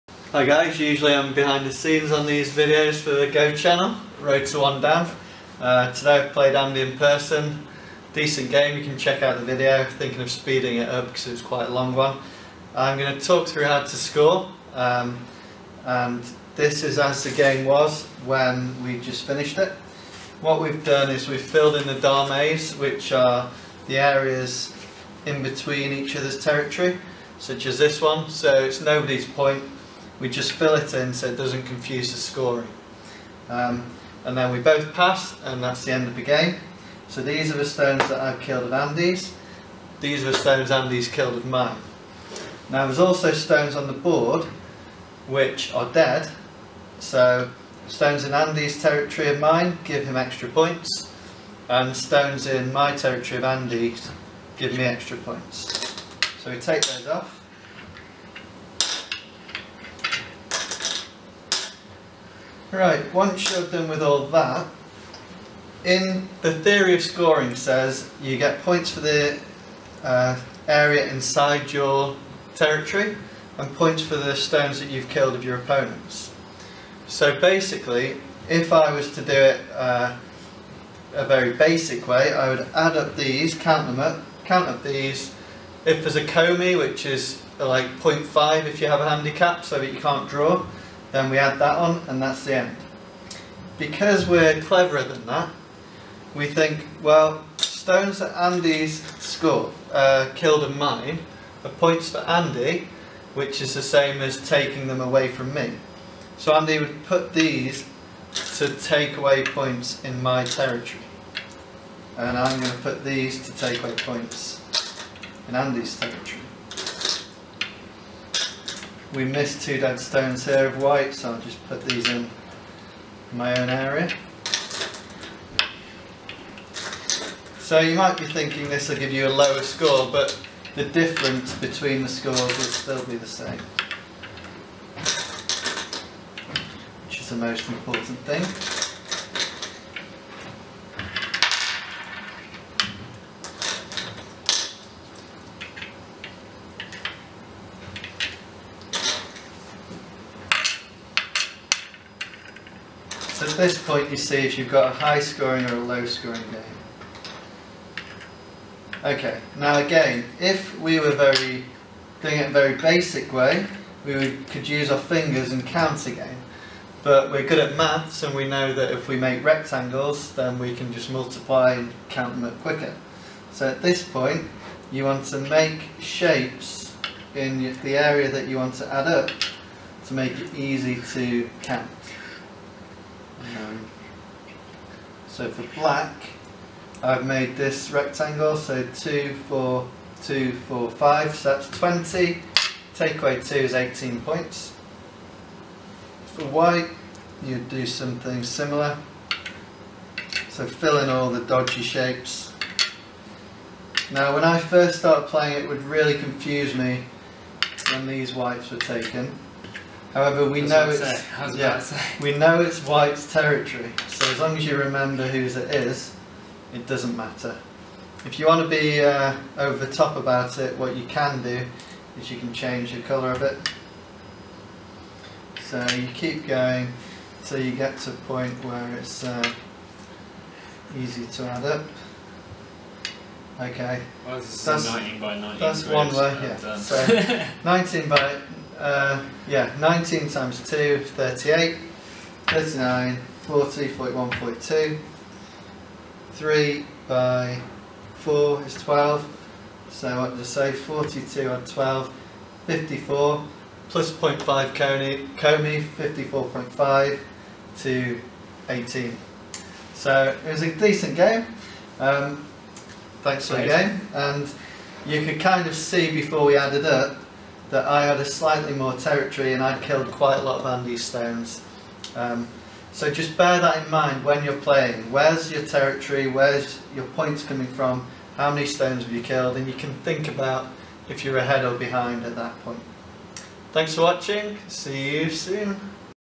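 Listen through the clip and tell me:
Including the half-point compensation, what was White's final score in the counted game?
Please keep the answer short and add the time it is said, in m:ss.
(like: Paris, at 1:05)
54.5, at 4:15.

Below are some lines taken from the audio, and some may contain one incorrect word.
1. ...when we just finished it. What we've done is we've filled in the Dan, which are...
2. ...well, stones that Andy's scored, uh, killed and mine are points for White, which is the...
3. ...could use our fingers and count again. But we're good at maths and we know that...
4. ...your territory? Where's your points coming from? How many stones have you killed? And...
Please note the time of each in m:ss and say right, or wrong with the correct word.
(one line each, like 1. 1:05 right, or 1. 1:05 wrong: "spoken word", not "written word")
1. 0:18 wrong: "Dames", not "Dan"
2. 1:37 wrong: "Andy", not "White"
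3. 2:44 right
4. 4:35 right.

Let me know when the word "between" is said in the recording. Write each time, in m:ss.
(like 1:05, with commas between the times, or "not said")
0:25, 2:11.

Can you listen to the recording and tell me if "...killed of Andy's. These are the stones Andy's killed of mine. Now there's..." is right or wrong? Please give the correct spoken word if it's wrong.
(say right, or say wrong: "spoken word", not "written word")
right.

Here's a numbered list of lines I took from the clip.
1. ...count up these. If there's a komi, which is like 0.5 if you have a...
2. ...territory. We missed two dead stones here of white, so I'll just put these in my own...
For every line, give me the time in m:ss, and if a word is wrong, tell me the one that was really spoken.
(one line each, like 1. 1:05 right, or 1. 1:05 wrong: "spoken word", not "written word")
1. 1:24 right
2. 1:55 right.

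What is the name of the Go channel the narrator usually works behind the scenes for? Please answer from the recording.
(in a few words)
Road to One Dan.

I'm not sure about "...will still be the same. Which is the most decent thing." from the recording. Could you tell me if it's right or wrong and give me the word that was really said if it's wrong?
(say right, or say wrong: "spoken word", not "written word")
wrong: "important", not "decent".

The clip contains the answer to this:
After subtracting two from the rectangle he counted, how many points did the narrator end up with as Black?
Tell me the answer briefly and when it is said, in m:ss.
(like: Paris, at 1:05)
18, at 3:13.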